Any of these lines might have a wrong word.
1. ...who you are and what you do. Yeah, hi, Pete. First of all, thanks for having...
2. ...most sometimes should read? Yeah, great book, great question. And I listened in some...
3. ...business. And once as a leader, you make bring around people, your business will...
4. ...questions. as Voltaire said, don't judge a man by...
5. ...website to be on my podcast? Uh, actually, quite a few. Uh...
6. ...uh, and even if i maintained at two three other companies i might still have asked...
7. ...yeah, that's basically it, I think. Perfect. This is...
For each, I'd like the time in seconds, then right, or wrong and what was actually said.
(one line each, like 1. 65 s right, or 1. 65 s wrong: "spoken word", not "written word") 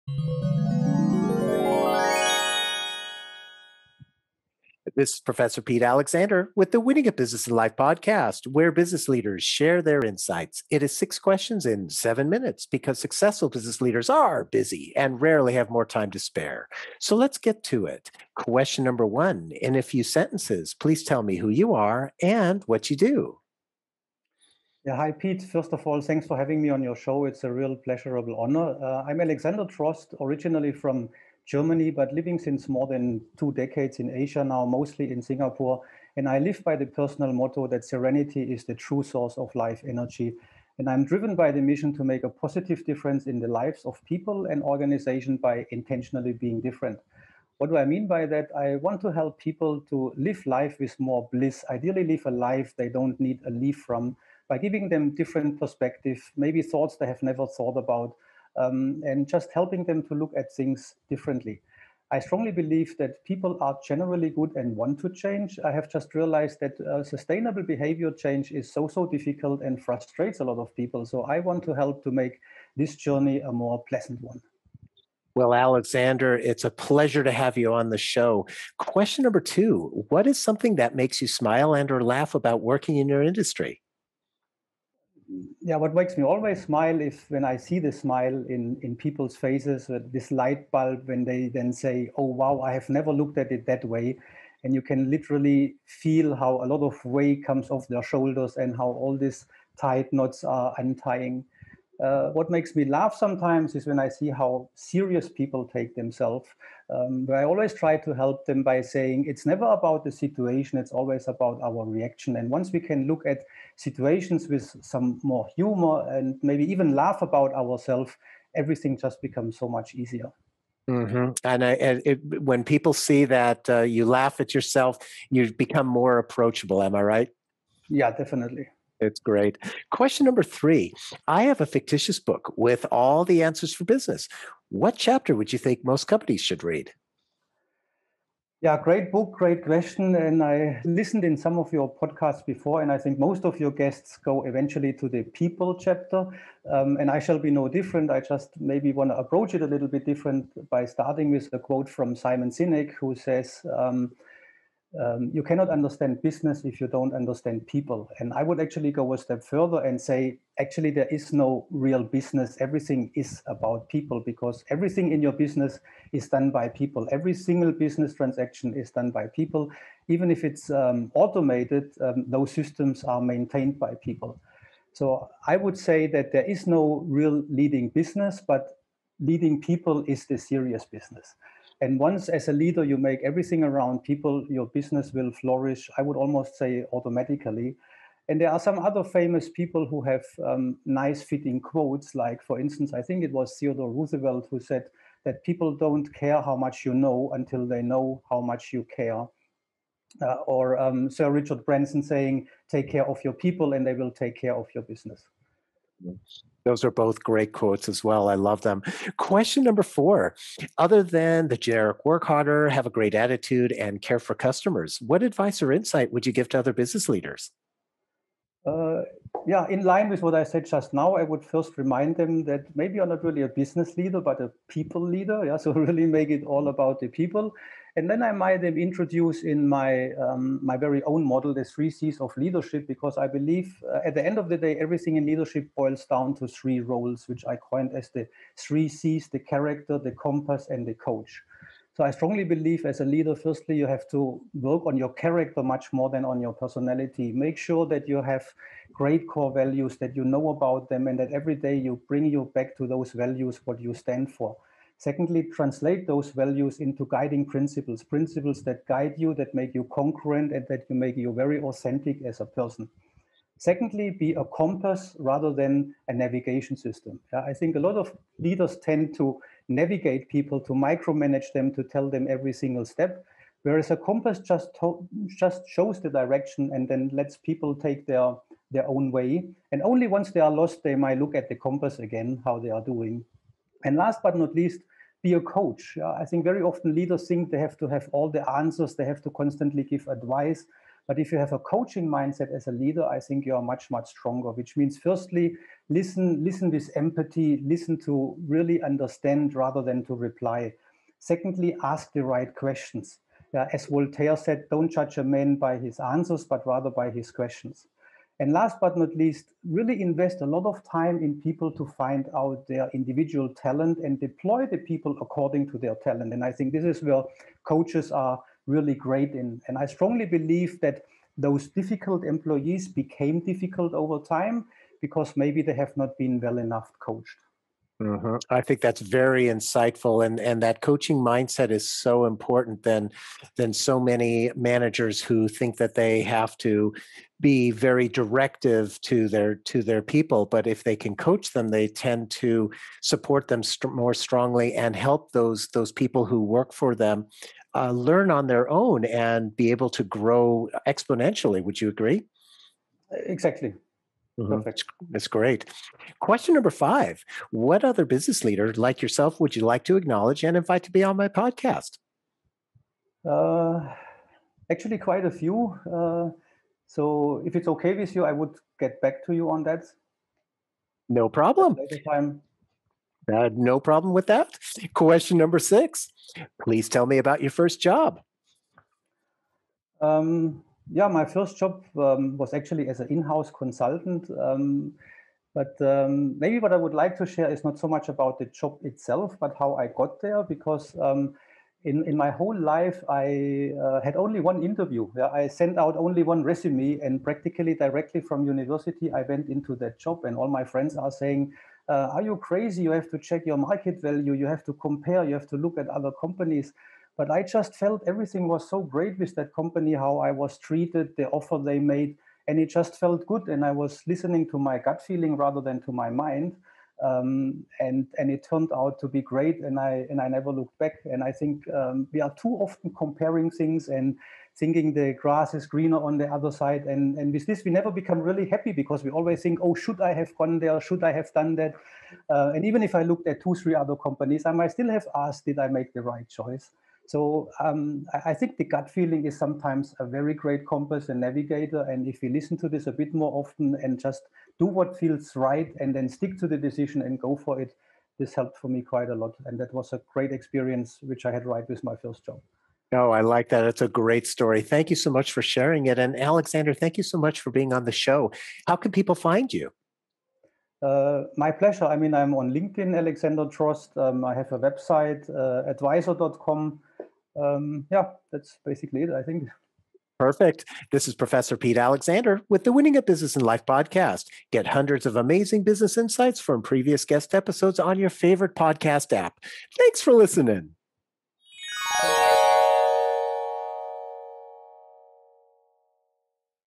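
1. 21 s right
2. 135 s wrong: "companies", not "sometimes"
3. 180 s wrong: "everything", not "bring"
4. 302 s right
5. 360 s wrong: "invite", not "website"
6. 432 s wrong: "looked", not "maintained"
7. 467 s right.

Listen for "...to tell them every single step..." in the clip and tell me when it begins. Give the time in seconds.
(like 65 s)
271 s.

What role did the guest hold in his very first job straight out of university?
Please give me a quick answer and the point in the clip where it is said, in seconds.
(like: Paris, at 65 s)
in-house consultant, at 383 s.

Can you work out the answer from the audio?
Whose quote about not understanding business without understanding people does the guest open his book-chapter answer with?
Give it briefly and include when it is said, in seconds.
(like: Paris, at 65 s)
Simon Sinek, at 152 s.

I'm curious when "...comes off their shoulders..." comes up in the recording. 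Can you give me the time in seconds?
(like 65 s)
97 s.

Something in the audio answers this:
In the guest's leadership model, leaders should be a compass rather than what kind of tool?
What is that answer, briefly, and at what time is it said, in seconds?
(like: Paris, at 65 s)
navigation system, at 266 s.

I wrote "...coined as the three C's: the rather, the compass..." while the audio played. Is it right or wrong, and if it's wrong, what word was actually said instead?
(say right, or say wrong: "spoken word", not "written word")
wrong: "character", not "rather".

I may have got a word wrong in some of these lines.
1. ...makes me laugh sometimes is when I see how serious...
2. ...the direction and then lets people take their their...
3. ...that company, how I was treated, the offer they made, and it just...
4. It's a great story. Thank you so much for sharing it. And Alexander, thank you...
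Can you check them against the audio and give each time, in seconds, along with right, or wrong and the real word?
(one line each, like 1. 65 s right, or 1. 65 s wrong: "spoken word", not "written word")
1. 102 s right
2. 275 s right
3. 409 s right
4. 453 s right.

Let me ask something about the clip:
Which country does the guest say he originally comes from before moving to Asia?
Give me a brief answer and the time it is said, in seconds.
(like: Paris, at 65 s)
Germany, at 31 s.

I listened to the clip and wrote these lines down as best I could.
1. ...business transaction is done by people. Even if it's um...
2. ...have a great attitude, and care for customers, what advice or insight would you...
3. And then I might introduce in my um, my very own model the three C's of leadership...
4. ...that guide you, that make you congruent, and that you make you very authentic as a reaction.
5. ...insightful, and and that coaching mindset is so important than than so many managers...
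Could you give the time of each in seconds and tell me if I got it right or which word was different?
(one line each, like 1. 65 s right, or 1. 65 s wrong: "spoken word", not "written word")
1. 167 s right
2. 212 s right
3. 227 s right
4. 258 s wrong: "person", not "reaction"
5. 329 s right.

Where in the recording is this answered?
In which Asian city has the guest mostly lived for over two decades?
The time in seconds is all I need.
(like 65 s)
35 s.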